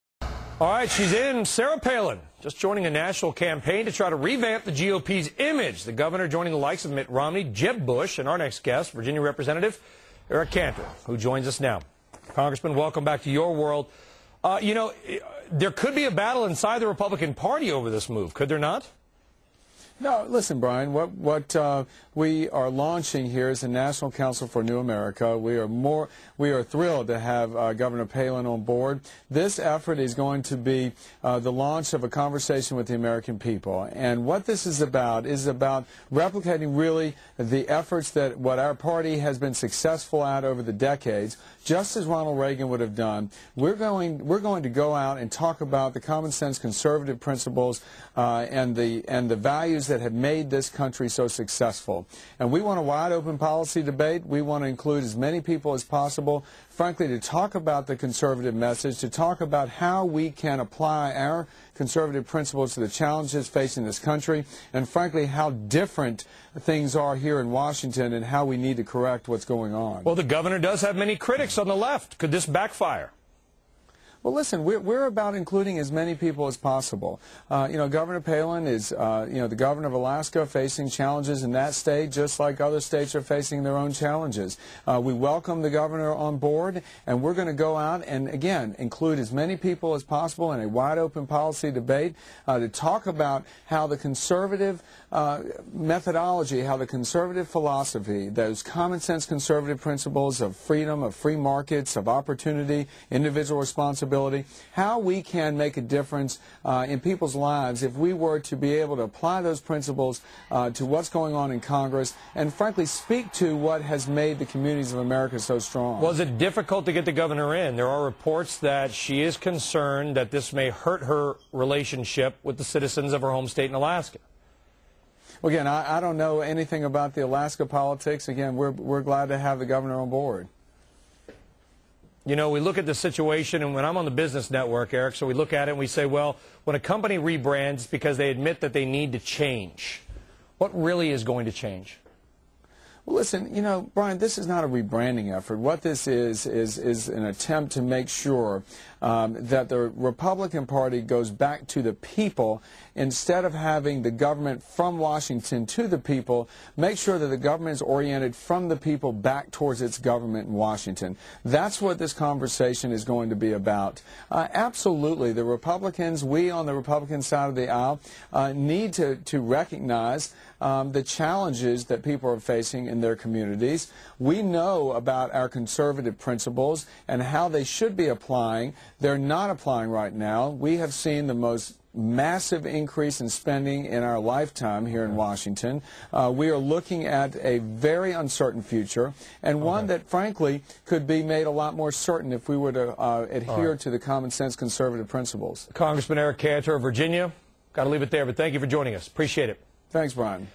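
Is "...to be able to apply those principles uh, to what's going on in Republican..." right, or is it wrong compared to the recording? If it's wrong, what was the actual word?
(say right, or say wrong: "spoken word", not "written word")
wrong: "Congress", not "Republican".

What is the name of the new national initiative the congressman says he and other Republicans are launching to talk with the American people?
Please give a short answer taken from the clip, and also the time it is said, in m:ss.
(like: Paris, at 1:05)
National Council for New America, at 0:23.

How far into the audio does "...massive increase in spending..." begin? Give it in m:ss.
3:01.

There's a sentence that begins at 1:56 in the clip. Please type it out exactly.
Was it difficult to get the governor in?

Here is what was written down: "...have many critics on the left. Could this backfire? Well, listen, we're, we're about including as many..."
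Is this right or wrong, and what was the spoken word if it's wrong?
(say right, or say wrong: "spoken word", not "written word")
right.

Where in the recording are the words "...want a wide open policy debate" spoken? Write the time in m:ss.
0:52.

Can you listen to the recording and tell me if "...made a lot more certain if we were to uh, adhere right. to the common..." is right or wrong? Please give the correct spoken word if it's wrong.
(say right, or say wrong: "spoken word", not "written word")
right.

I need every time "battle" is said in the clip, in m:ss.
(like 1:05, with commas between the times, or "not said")
0:16.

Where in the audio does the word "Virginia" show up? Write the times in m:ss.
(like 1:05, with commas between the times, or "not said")
0:08, 3:16.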